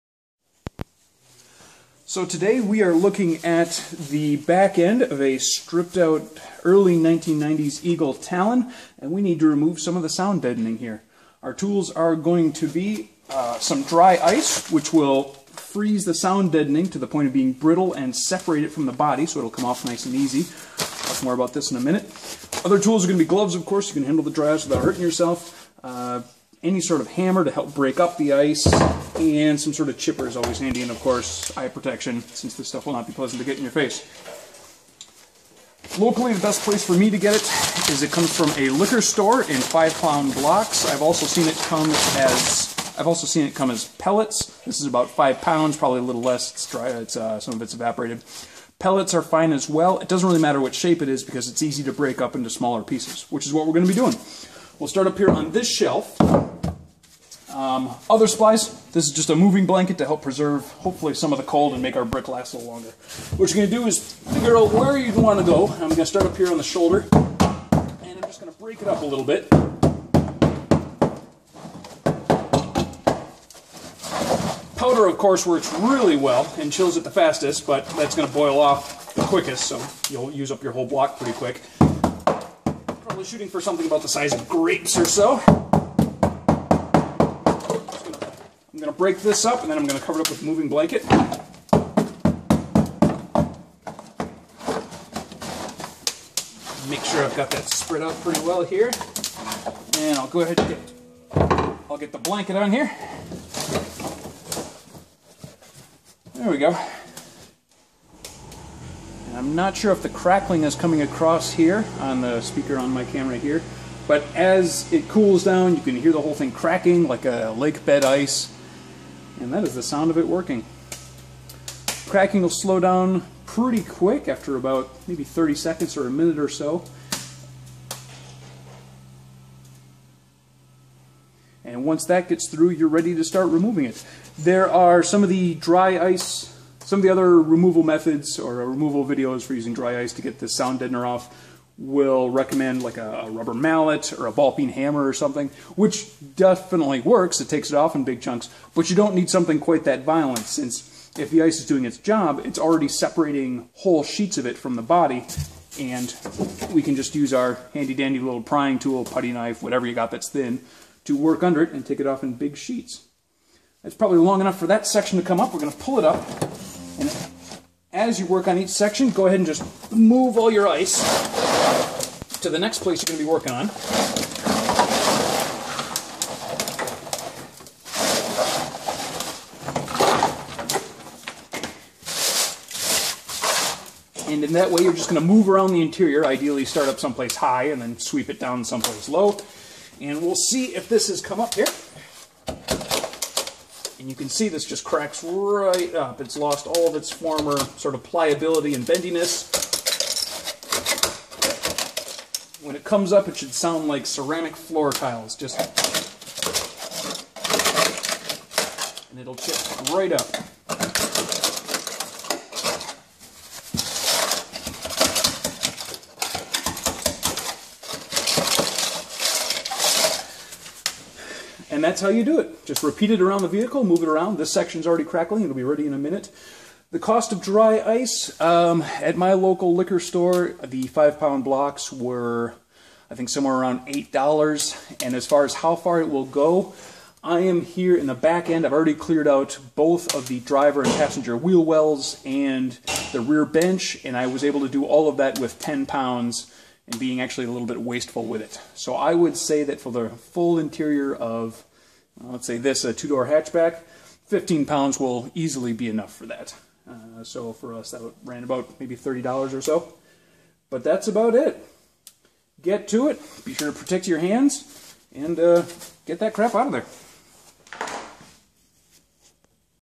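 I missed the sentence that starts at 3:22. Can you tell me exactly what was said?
When it comes up, it should sound like ceramic floor tiles, just...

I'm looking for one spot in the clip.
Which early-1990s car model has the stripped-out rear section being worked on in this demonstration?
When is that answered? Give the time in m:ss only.
0:07.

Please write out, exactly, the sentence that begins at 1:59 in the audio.
And that is the sound of it working.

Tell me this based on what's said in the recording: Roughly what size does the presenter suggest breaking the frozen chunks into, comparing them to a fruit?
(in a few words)
grapes.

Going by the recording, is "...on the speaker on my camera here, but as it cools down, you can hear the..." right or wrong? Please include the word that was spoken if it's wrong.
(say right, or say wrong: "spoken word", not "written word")
right.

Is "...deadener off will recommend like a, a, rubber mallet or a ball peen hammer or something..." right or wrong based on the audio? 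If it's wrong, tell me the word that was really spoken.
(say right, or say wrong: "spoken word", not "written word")
right.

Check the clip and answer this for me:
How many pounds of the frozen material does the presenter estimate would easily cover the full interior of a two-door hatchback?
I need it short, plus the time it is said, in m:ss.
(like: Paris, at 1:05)
15 pounds, at 4:14.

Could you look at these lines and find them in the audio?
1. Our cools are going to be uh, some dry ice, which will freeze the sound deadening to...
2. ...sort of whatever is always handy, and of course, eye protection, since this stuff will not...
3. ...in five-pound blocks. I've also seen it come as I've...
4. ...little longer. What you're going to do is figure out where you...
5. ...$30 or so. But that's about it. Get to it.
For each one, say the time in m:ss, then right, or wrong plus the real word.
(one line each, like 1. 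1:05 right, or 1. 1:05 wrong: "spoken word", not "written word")
1. 0:11 wrong: "tools", not "cools"
2. 0:29 wrong: "chipper", not "whatever"
3. 0:39 right
4. 1:02 right
5. 4:18 right.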